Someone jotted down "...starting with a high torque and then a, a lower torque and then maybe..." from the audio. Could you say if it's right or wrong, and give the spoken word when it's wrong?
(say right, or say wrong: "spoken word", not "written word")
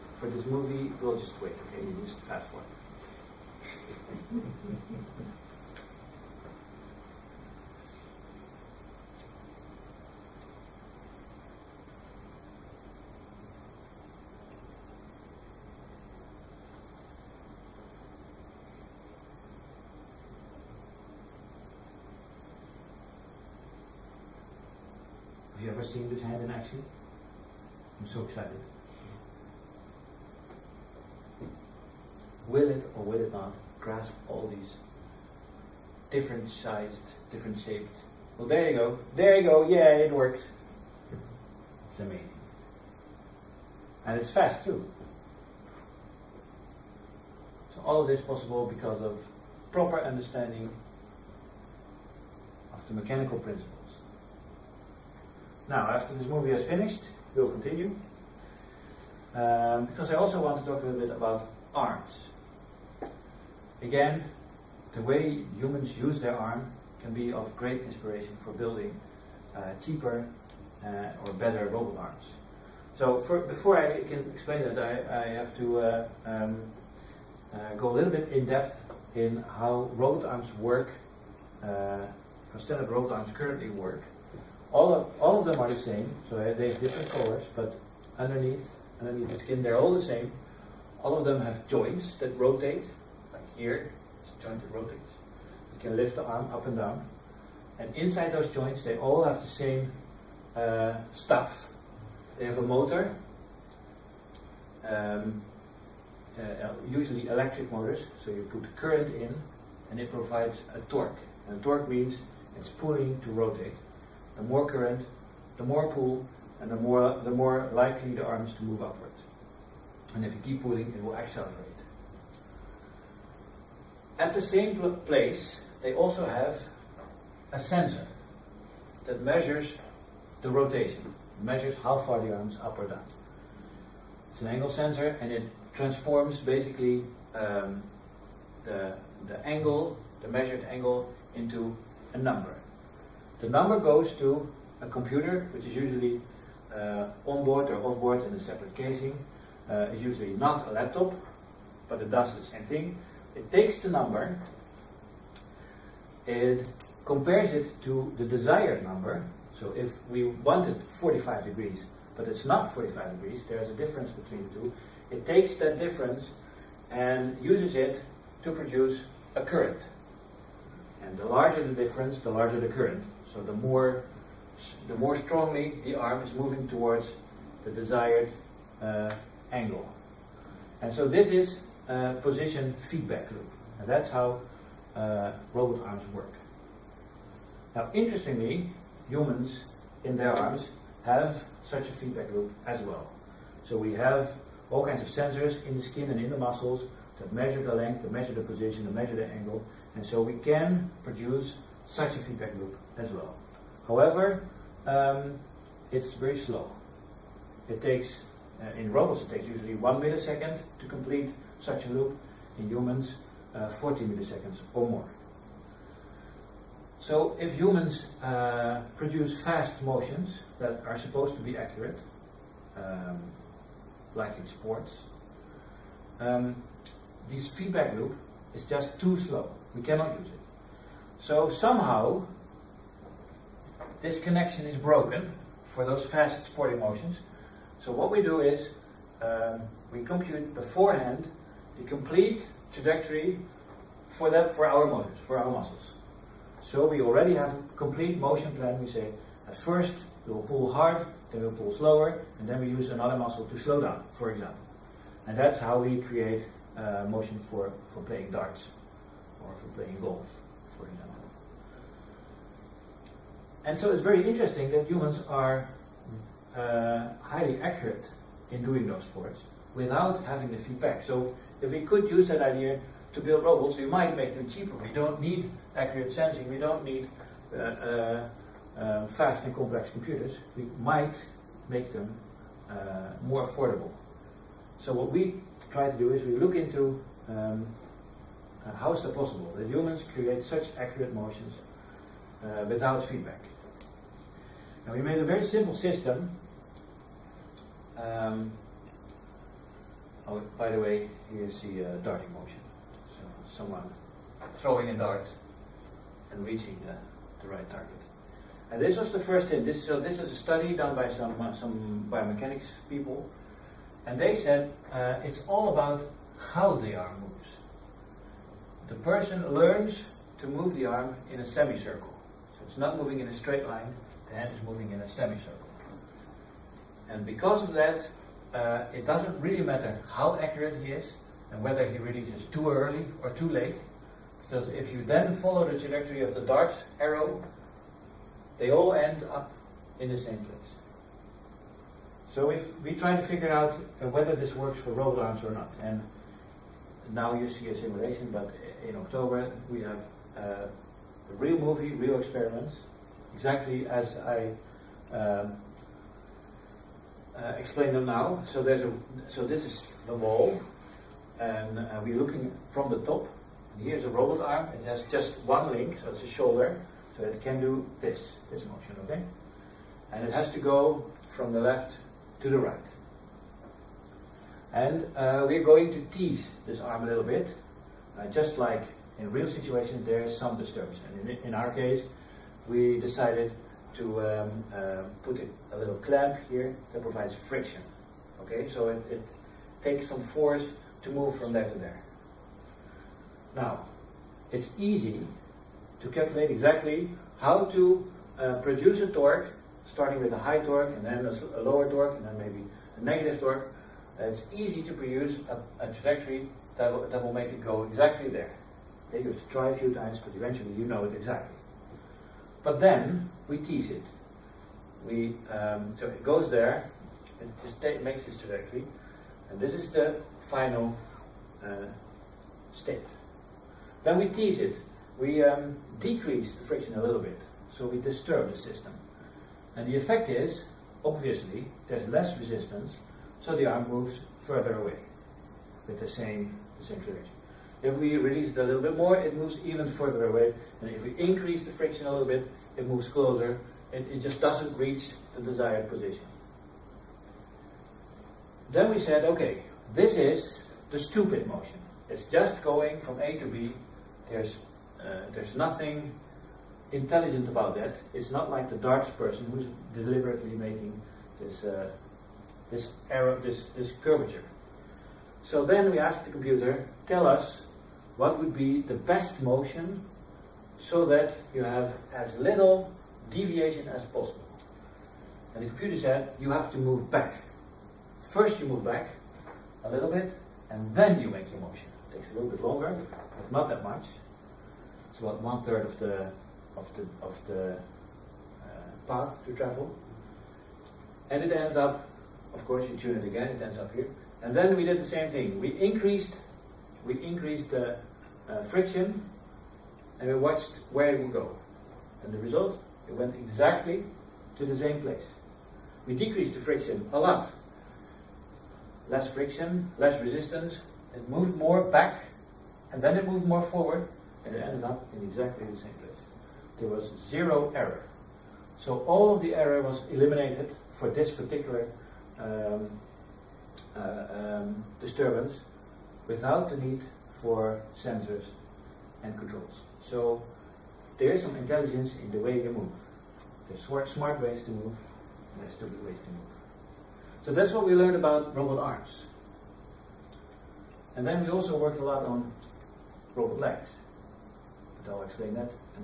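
right.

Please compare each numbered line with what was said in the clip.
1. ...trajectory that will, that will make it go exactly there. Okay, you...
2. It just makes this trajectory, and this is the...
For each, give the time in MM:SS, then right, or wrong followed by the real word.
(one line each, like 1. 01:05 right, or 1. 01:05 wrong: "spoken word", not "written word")
1. 06:45 right
2. 06:57 right.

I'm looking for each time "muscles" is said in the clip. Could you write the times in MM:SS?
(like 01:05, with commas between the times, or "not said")
03:16, 04:05, 04:13.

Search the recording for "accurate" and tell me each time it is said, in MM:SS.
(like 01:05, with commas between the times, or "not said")
03:41, 04:27, 04:35, 04:50, 05:30.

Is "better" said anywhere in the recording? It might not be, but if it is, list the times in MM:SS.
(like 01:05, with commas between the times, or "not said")
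01:11.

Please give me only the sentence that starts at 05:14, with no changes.
And they said uh, it's all about how the arm moves.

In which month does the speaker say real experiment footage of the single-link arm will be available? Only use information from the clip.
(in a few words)
October.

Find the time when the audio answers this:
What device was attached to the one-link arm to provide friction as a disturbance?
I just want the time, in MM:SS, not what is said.
06:25.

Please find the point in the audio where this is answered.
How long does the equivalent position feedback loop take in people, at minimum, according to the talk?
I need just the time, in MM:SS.
03:33.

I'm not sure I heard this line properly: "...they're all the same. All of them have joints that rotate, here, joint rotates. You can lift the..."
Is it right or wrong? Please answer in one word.
right.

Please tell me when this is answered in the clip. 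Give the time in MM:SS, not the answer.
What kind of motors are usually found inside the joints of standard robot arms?
01:47.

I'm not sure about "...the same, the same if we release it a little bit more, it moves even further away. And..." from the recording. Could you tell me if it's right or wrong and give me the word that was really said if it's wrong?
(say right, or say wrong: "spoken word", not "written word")
right.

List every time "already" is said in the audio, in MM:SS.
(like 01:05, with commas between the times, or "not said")
04:07.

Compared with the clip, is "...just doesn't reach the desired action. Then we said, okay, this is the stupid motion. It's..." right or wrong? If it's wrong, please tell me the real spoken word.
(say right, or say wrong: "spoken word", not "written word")
wrong: "position", not "action".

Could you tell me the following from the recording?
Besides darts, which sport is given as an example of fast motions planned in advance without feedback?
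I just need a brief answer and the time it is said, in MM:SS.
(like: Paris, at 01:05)
golf, at 04:20.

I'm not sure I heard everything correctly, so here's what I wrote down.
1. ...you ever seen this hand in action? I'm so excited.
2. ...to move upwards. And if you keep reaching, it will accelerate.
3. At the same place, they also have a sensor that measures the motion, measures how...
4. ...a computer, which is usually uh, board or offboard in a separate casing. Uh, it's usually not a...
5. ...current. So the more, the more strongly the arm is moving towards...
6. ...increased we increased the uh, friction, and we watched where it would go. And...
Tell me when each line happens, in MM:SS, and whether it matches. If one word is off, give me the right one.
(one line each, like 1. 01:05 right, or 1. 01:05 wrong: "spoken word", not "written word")
1. 00:25 right
2. 01:58 wrong: "pulling", not "reaching"
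3. 02:04 wrong: "rotation", not "motion"
4. 02:24 right
5. 02:52 right
6. 08:15 right.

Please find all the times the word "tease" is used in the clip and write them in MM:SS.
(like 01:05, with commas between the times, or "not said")
06:16, 06:53, 07:04.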